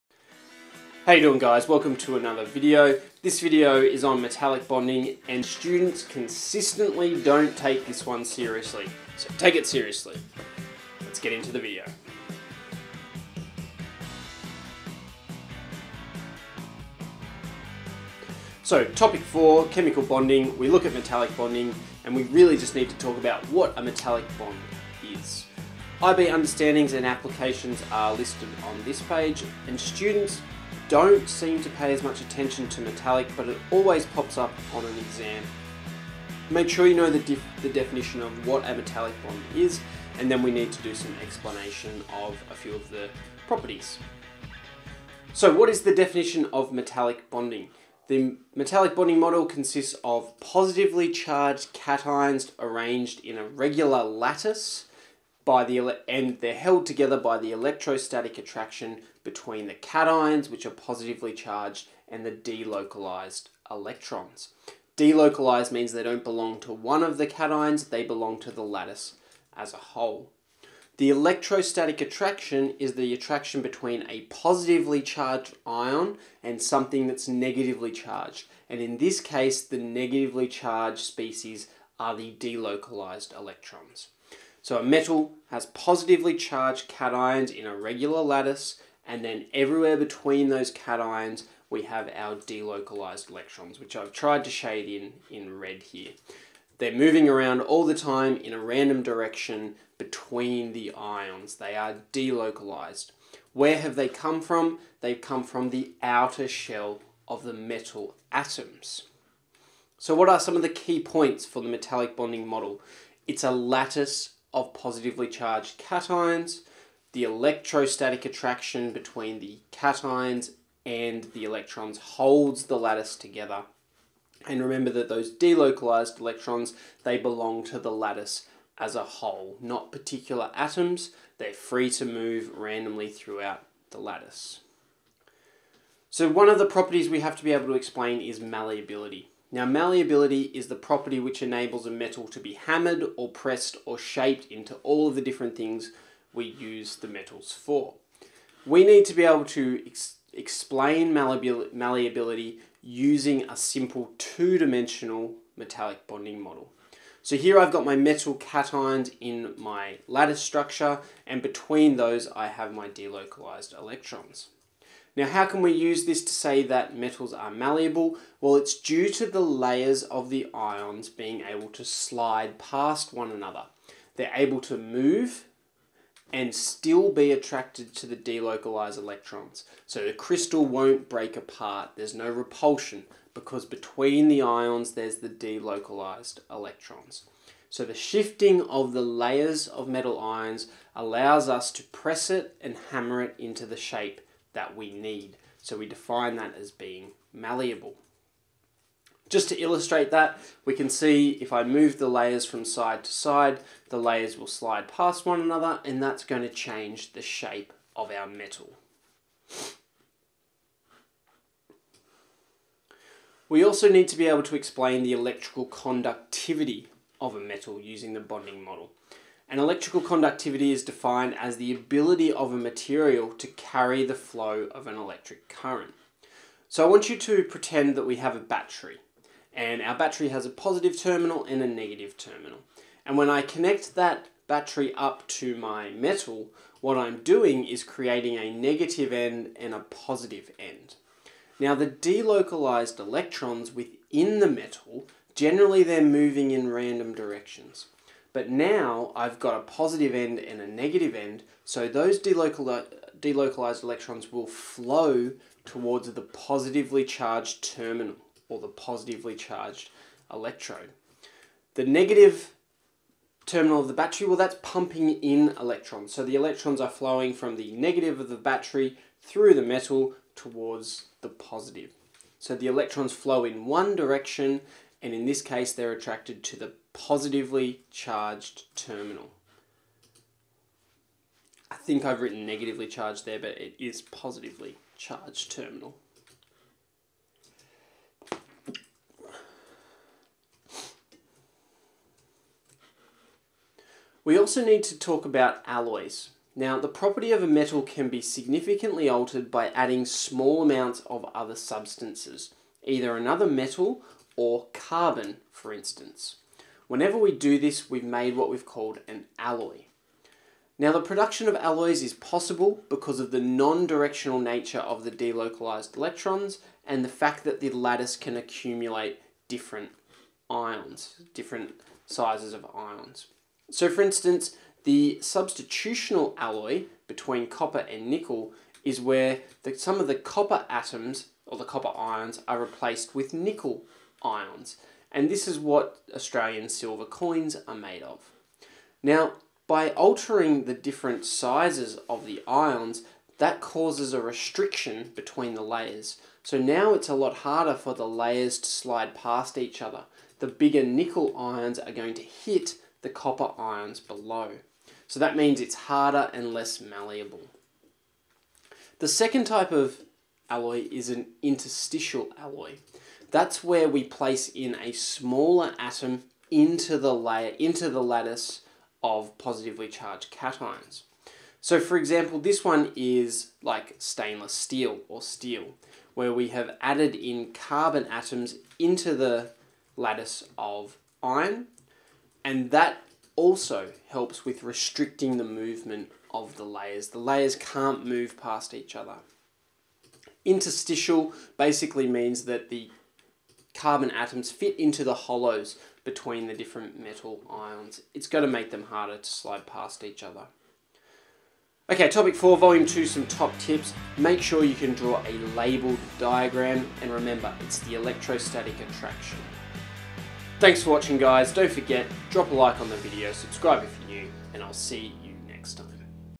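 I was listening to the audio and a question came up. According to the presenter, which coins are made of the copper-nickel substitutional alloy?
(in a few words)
Australian silver coins.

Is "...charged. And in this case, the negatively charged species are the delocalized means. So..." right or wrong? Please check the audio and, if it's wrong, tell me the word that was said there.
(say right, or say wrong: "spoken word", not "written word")
wrong: "electrons", not "means".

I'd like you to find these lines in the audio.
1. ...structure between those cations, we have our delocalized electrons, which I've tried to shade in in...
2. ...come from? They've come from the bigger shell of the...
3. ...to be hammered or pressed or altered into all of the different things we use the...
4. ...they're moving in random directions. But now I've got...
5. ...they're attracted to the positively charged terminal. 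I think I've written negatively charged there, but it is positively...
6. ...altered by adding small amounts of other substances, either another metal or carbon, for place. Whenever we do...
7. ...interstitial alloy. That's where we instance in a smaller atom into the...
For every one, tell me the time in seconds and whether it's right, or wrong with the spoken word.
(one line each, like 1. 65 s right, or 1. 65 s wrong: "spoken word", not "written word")
1. 89 s wrong: "everywhere", not "structure"
2. 104 s wrong: "outer", not "bigger"
3. 142 s wrong: "shaped", not "altered"
4. 245 s right
5. 275 s right
6. 299 s wrong: "instance", not "place"
7. 361 s wrong: "place", not "instance".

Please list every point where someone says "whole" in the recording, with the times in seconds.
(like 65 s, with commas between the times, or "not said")
69 s, 129 s.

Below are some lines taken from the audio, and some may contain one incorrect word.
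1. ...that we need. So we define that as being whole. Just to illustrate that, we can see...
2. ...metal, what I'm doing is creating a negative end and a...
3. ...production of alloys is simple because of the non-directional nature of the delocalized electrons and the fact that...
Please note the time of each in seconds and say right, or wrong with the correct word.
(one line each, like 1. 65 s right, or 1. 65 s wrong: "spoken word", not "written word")
1. 194 s wrong: "malleable", not "whole"
2. 235 s right
3. 310 s wrong: "possible", not "simple".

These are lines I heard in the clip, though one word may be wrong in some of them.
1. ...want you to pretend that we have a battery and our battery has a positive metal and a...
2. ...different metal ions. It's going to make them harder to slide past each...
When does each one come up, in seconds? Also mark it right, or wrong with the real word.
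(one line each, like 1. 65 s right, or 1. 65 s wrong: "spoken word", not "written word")
1. 226 s wrong: "terminal", not "metal"
2. 396 s right.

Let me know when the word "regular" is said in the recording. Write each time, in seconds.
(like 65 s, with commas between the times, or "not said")
53 s, 87 s.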